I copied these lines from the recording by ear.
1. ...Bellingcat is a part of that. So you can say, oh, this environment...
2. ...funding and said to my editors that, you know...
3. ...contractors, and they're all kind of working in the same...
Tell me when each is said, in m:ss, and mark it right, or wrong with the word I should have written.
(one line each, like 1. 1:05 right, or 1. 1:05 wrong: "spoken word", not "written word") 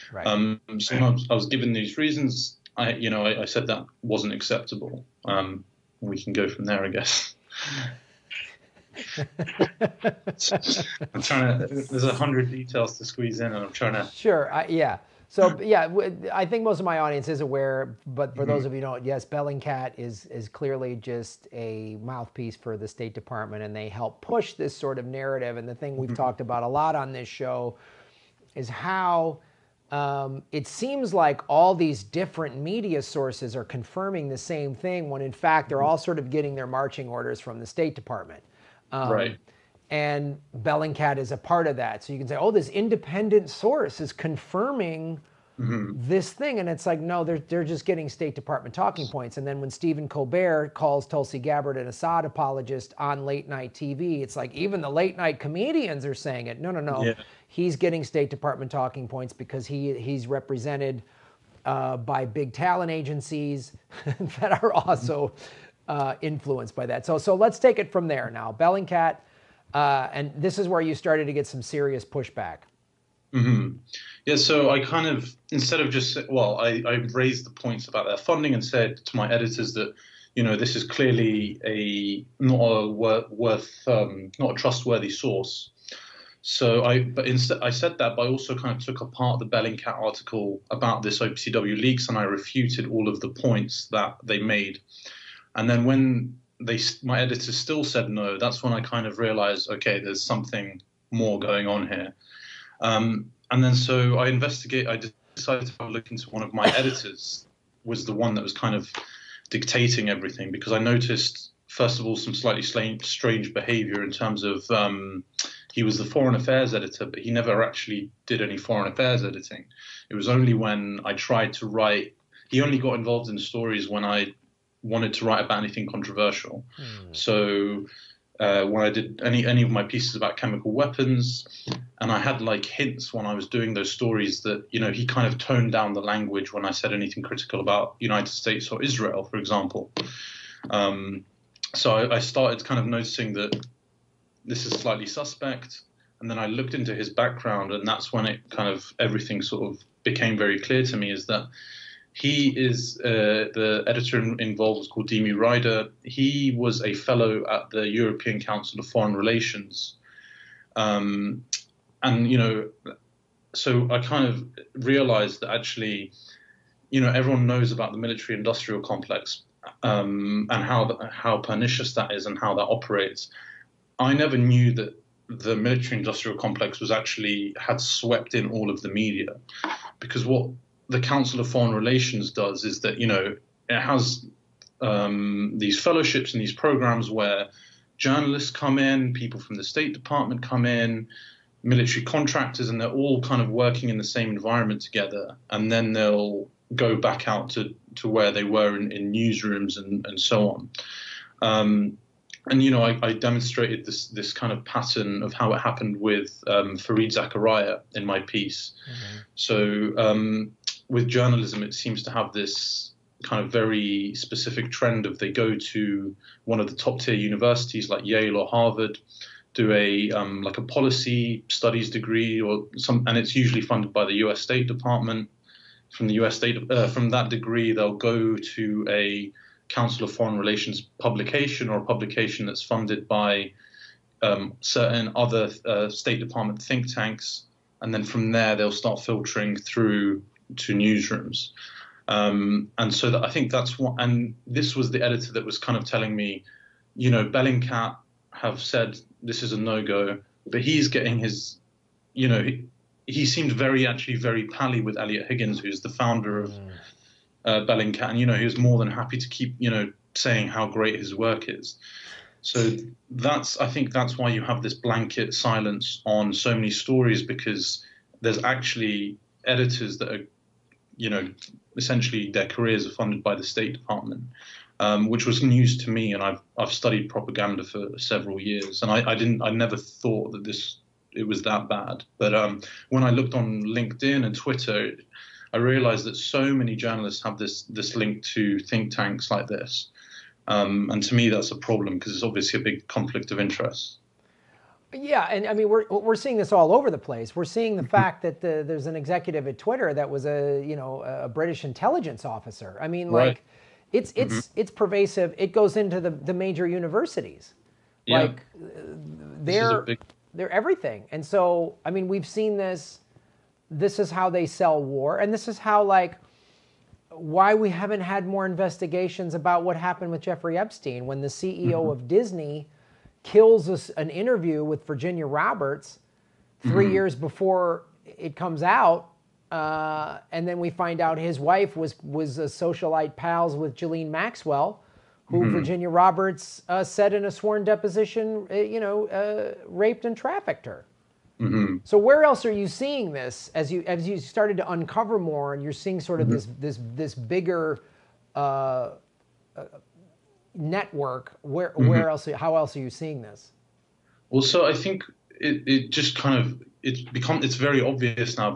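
1. 0:40 wrong: "independent", not "environment"
2. 1:18 right
3. 3:12 right.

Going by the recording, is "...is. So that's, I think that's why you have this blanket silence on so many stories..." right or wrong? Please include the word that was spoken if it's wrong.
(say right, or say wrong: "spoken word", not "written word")
right.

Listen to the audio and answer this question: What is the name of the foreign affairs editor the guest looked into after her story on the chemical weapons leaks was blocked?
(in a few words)
Dimi Reider.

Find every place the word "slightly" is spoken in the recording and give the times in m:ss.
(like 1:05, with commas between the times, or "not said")
1:52, 2:24.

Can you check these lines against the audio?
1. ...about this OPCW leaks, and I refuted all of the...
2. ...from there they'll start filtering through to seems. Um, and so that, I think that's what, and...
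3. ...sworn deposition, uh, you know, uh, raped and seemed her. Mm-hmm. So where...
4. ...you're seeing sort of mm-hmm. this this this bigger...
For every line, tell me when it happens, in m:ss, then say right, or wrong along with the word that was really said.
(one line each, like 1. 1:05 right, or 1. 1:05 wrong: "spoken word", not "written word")
1. 1:30 right
2. 3:58 wrong: "newsrooms", not "seems"
3. 5:37 wrong: "trafficked", not "seemed"
4. 5:45 right.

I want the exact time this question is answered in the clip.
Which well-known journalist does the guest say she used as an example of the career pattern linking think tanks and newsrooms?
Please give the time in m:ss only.
3:26.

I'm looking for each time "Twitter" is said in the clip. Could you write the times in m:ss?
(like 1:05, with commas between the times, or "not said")
4:44, 4:59.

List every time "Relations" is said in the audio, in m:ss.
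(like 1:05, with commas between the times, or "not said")
2:39, 3:01, 3:50.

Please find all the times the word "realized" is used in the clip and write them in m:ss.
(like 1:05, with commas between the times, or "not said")
1:39, 2:44, 4:45.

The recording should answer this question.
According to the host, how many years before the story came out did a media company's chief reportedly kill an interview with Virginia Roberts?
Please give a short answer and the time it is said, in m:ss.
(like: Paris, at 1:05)
3, at 5:26.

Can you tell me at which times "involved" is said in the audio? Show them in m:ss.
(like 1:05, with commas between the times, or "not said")
2:02, 2:34.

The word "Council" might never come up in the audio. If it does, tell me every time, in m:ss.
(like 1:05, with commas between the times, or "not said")
2:38, 3:00, 3:49.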